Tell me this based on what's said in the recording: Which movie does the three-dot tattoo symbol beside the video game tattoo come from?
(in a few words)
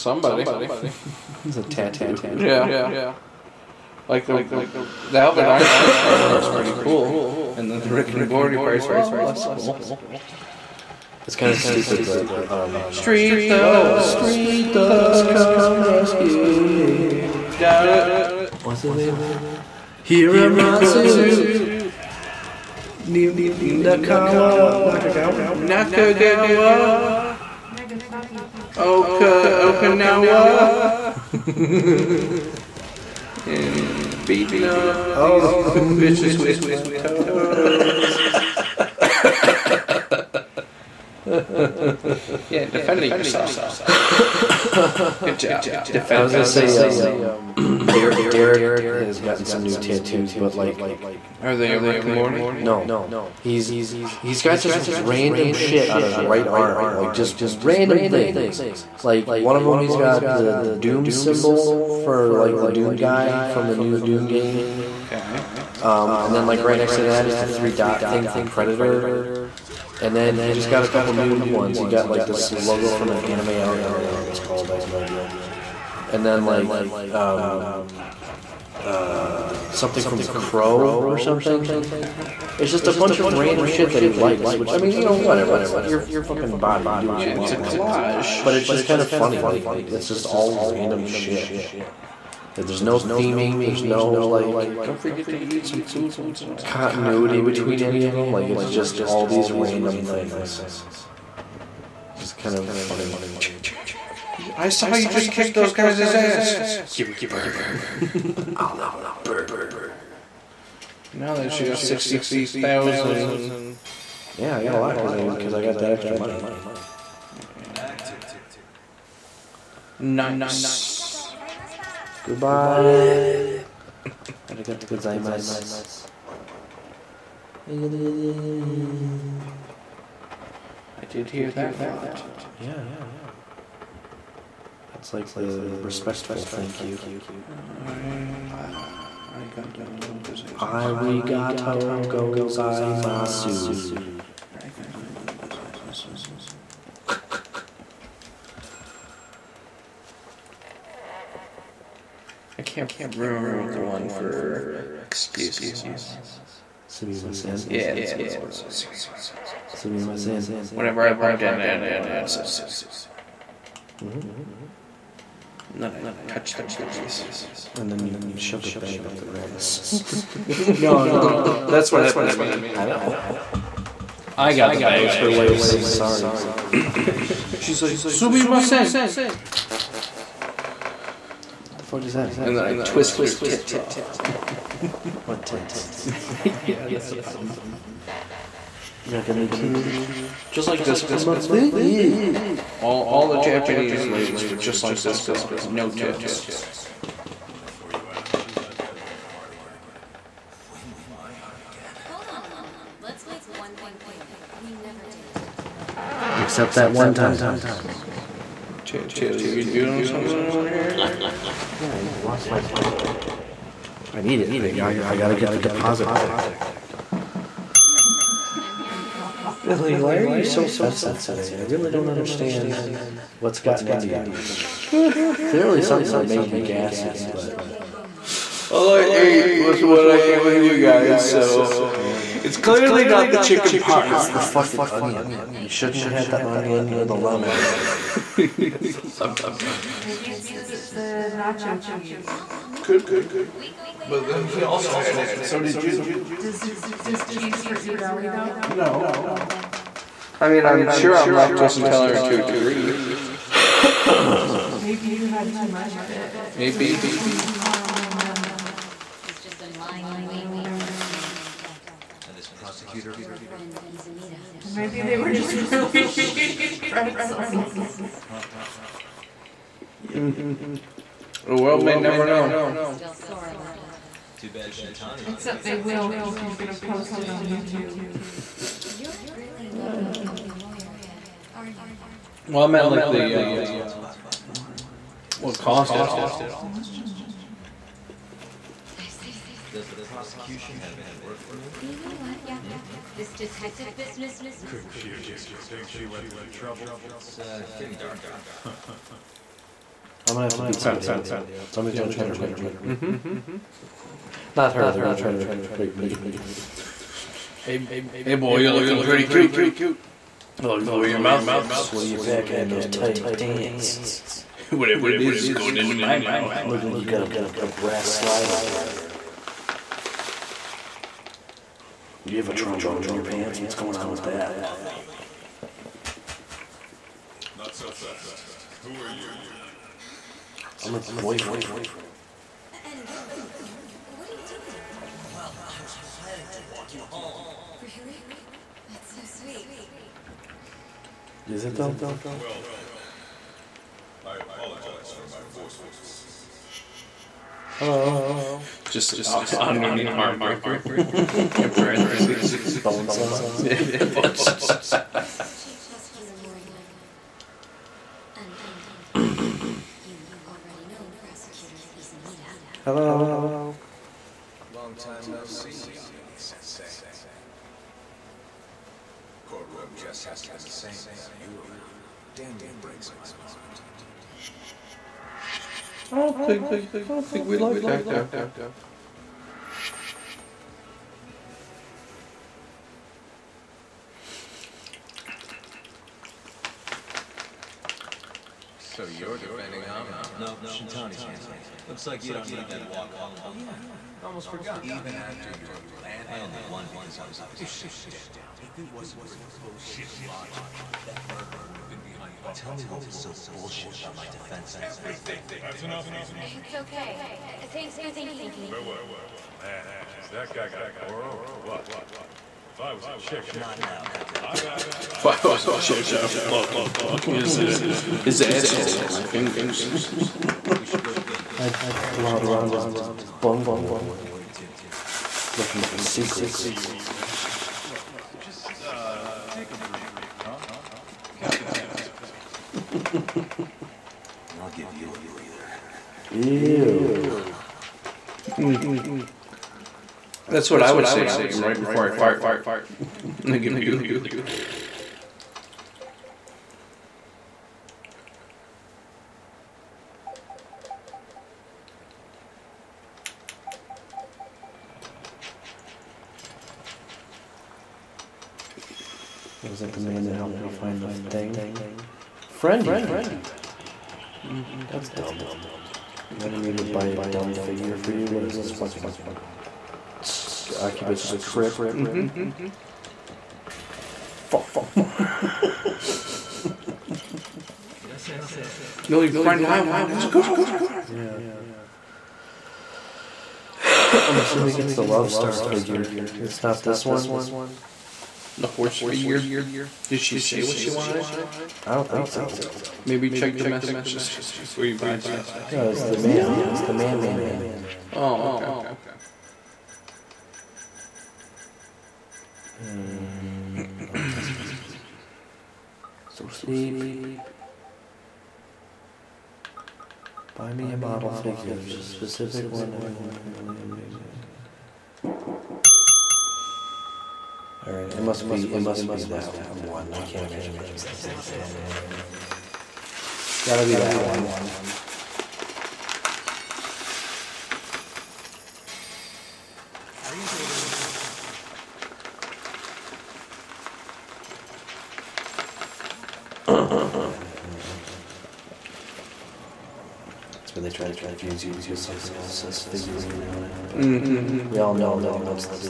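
Predator.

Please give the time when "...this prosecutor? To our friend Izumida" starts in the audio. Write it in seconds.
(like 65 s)
262 s.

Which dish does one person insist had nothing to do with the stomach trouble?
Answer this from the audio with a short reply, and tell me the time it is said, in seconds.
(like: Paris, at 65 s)
chicken parm, at 233 s.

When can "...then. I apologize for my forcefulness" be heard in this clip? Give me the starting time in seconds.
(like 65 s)
344 s.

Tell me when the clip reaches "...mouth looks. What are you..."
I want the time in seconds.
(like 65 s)
311 s.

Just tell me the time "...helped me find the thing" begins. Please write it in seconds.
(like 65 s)
460 s.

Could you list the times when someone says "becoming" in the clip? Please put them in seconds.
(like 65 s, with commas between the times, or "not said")
280 s.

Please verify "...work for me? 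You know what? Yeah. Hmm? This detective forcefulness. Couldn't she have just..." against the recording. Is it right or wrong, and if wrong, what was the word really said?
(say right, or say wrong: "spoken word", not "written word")
wrong: "business", not "forcefulness".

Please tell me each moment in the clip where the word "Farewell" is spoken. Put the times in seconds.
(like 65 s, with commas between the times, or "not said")
408 s.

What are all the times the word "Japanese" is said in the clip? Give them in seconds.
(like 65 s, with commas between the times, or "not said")
193 s.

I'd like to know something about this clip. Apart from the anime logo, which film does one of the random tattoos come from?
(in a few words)
The Crow.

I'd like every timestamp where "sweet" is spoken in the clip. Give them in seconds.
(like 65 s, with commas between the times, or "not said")
339 s.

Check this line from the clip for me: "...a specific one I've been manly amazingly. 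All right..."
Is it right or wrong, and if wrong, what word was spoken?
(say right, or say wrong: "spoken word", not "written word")
wrong: "apparently", not "manly".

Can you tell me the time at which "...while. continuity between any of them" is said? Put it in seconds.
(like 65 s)
96 s.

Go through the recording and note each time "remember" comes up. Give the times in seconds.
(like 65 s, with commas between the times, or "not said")
73 s, 153 s.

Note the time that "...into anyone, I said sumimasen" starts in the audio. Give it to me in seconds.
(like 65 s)
161 s.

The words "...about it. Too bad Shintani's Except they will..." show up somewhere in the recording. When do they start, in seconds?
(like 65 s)
273 s.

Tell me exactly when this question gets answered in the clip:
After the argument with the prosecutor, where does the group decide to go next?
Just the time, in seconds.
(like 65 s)
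421 s.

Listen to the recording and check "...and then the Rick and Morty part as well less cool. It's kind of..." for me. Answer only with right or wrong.
right.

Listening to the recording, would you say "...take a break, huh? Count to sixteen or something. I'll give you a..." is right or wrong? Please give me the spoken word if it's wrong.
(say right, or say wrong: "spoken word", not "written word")
wrong: "ten", not "sixteen".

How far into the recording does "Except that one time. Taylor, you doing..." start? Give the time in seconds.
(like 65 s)
206 s.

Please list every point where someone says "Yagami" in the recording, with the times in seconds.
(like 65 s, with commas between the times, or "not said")
365 s.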